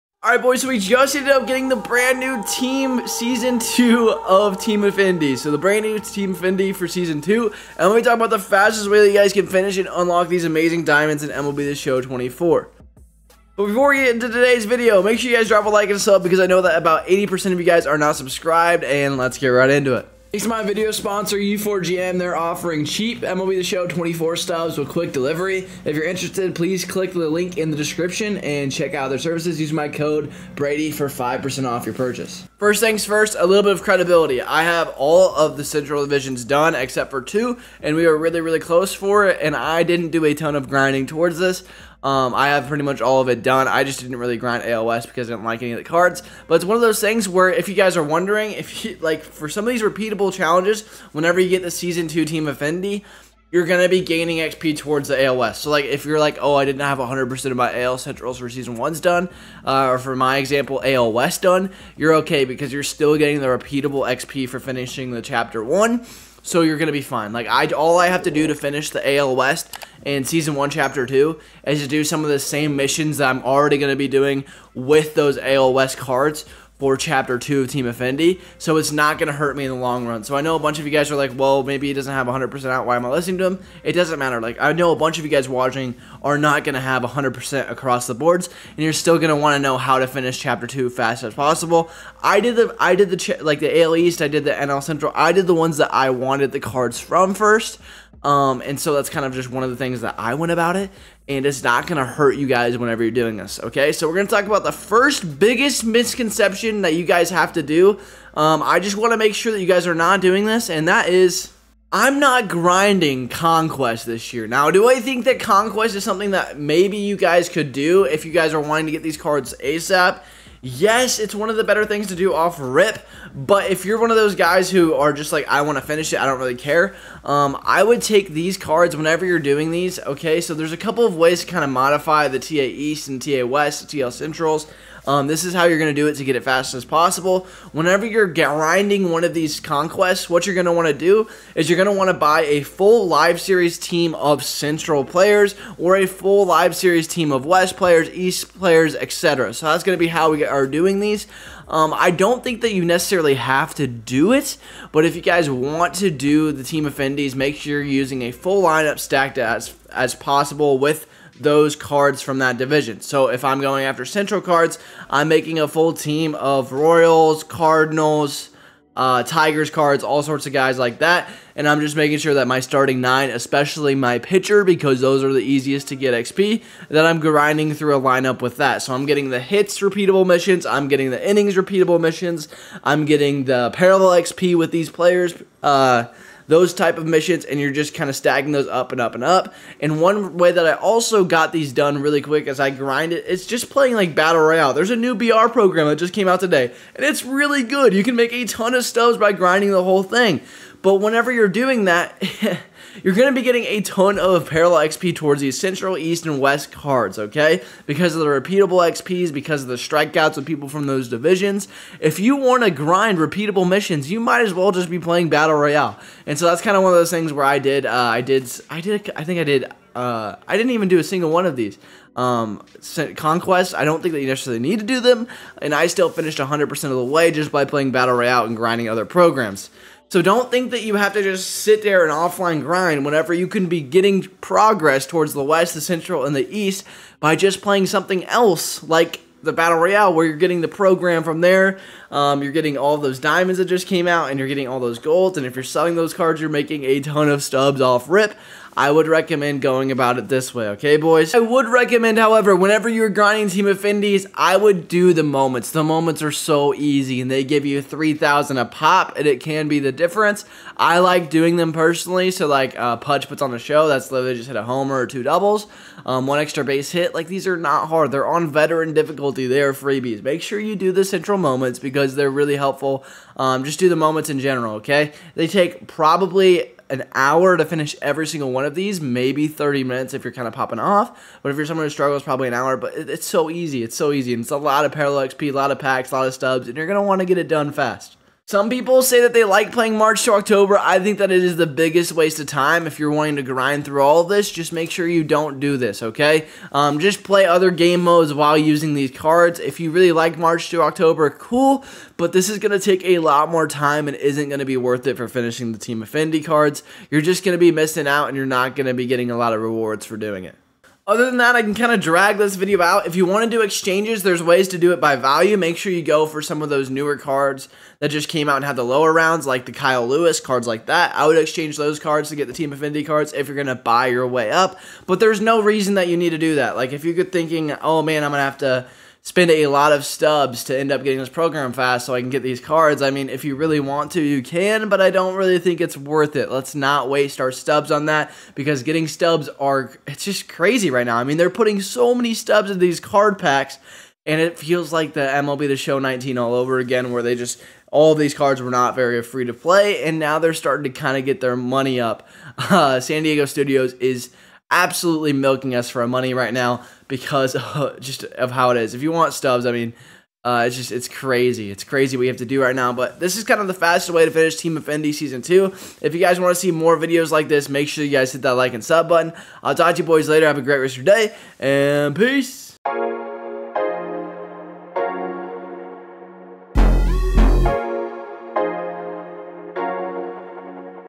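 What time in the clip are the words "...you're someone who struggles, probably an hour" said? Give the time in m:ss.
4:41.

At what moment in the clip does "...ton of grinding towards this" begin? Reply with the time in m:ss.
0:40.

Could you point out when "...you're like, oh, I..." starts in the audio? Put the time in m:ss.
0:56.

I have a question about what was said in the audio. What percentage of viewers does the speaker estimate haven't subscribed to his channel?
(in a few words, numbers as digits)
80%.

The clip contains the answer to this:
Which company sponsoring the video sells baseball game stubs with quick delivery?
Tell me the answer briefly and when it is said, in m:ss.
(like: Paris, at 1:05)
U4GM, at 0:21.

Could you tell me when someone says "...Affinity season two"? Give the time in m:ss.
6:04.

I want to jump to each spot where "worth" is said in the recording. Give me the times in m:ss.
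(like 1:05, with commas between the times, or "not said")
5:04, 5:35.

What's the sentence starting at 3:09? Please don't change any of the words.
And one way that I also got these done really quick as I grind it, it's just playing like Battle Royale.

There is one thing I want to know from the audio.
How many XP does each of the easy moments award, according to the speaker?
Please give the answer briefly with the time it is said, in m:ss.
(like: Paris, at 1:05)
3,000, at 4:17.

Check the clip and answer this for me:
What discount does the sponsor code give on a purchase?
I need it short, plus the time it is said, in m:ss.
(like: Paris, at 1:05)
5%, at 0:31.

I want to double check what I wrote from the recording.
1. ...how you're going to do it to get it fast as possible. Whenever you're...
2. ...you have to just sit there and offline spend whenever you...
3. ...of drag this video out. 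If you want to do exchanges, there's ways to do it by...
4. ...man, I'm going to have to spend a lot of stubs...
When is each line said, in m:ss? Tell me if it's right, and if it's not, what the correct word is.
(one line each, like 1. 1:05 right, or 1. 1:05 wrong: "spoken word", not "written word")
1. 2:15 right
2. 3:50 wrong: "grind", not "spend"
3. 5:11 right
4. 5:28 right.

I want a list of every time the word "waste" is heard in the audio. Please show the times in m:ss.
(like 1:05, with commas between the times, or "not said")
4:52, 5:37.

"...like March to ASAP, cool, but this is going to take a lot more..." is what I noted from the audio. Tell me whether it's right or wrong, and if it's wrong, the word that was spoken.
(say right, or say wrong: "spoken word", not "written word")
wrong: "October", not "ASAP".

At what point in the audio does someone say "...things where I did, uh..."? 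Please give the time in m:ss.
3:37.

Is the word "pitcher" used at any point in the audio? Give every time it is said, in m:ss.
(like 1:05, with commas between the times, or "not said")
2:54.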